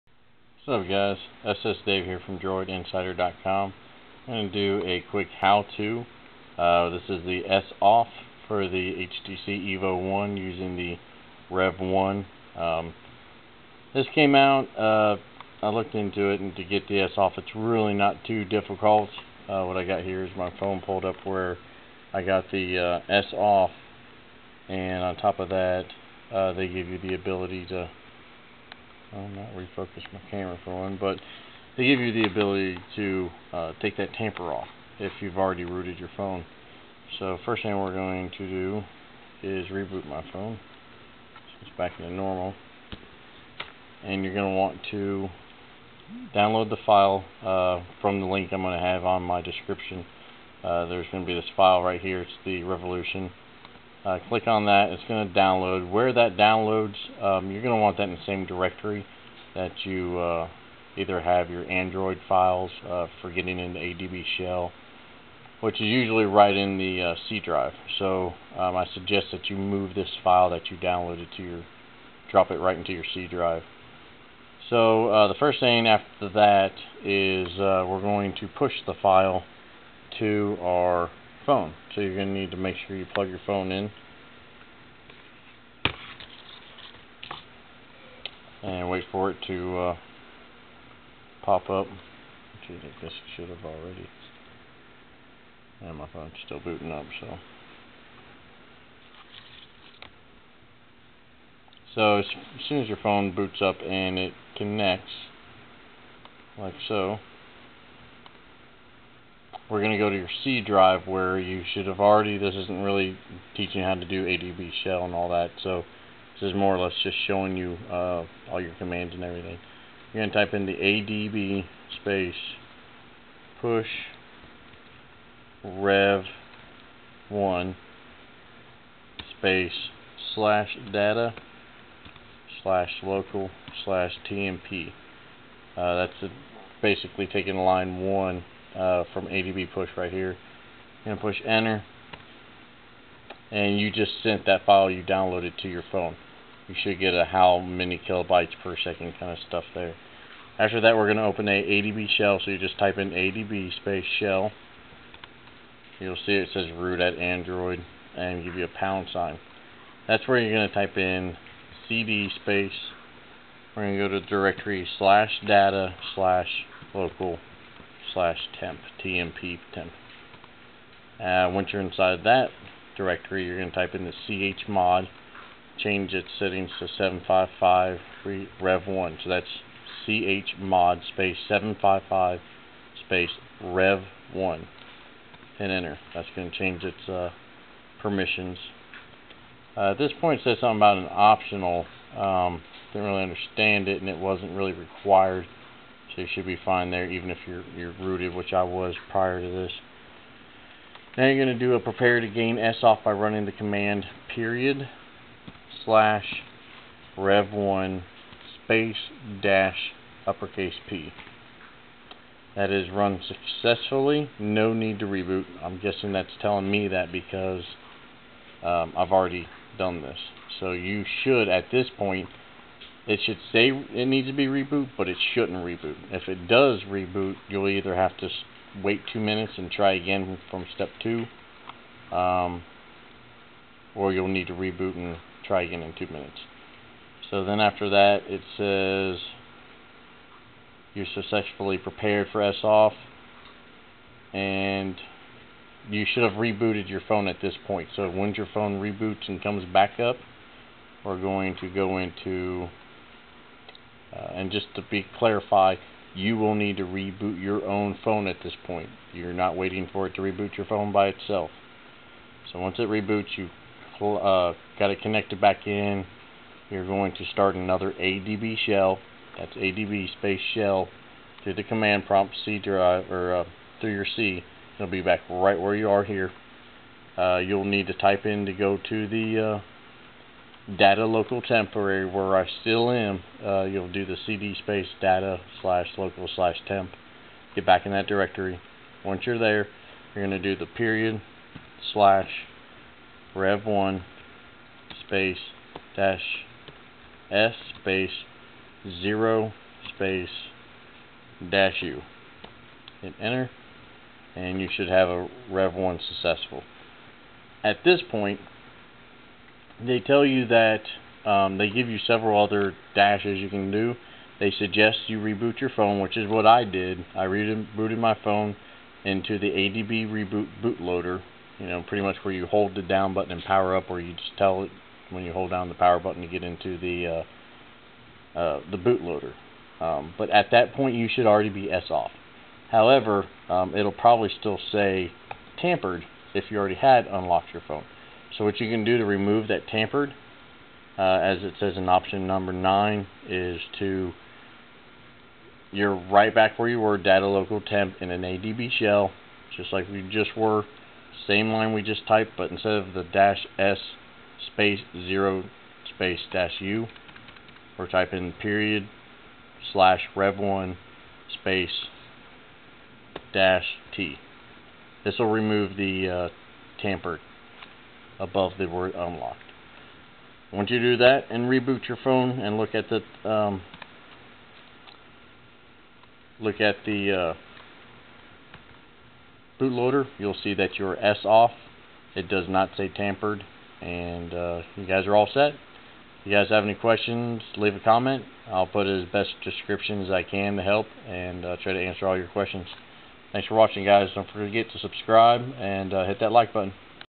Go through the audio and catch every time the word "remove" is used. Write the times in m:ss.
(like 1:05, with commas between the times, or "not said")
5:39, 6:05.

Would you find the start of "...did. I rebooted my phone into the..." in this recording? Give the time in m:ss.
5:16.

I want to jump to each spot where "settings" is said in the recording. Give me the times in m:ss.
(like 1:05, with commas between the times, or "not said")
2:56.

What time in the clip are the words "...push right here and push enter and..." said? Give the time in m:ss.
2:19.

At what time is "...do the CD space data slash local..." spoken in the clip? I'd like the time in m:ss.
4:43.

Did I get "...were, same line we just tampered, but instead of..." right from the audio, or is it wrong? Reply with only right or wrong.
wrong.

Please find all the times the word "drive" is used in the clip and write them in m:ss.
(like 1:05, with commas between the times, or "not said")
1:07, 1:13, 1:50, 4:32.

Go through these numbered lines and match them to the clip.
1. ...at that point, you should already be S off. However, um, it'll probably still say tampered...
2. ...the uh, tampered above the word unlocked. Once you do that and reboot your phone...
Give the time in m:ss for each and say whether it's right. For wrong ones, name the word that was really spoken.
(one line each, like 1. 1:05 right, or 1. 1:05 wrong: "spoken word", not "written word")
1. 5:30 right
2. 6:05 right.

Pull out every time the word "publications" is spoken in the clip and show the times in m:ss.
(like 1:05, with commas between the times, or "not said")
not said.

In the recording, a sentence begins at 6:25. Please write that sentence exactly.
If you guys have any questions, leave a comment.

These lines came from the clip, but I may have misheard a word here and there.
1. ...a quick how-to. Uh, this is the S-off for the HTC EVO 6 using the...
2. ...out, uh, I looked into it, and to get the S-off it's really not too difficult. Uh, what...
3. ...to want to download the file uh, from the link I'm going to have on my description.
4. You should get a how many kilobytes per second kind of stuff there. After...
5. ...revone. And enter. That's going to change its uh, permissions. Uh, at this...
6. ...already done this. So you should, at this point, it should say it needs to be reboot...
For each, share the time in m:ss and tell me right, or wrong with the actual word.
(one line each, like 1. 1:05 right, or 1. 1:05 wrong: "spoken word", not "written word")
1. 0:04 wrong: "1", not "6"
2. 0:14 right
3. 0:44 right
4. 2:26 right
5. 3:03 right
6. 3:39 right.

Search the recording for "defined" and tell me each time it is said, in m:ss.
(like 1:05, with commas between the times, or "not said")
not said.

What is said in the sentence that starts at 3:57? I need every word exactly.
So then after that, it says you're successfully prepared for S off, and you should have rebooted your phone at this point.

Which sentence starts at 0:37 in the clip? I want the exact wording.
So first thing we're going to do is reboot my phone.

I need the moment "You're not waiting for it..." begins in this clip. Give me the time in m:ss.
4:19.